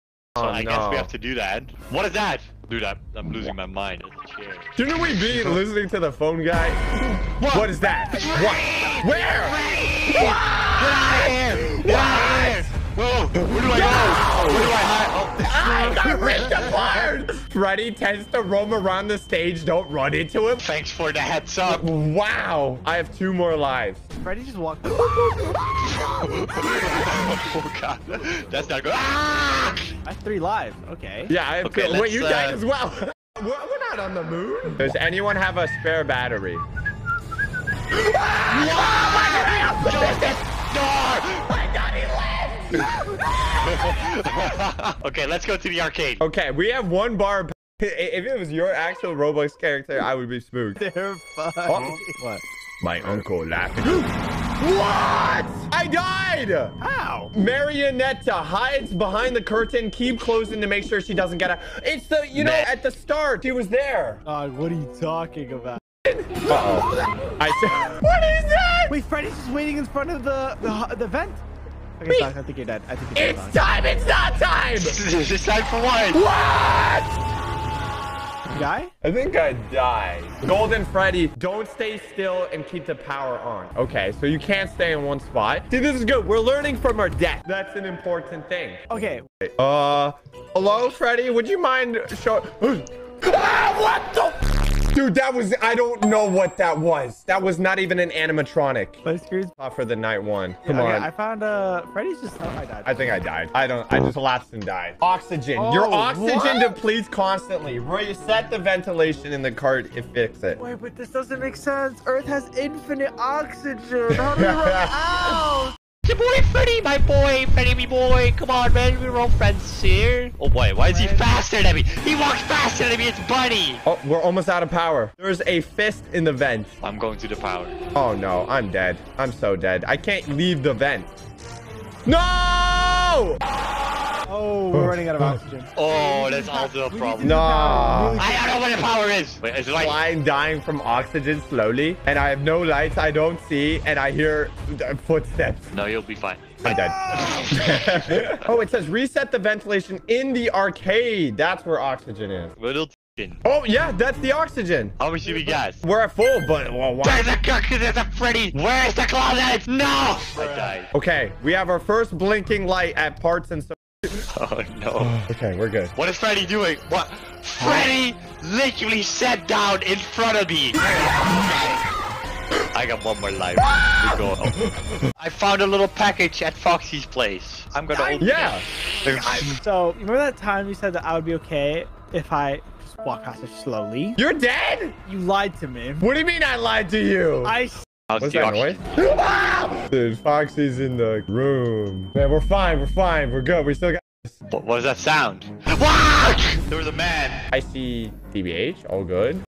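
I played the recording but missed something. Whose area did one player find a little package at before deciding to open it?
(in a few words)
Foxy's place.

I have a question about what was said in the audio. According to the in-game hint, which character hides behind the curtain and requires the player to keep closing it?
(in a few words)
Marionetta.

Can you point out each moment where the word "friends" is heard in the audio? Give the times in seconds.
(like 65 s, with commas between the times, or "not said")
119 s.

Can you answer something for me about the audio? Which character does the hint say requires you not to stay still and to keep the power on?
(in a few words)
Golden Freddy.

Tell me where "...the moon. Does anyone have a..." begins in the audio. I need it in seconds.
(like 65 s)
34 s.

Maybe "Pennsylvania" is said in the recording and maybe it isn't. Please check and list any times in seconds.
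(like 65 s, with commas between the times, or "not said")
not said.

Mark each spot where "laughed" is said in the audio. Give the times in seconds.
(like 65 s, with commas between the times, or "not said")
53 s.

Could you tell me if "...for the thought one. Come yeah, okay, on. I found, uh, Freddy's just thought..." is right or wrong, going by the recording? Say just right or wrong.
wrong.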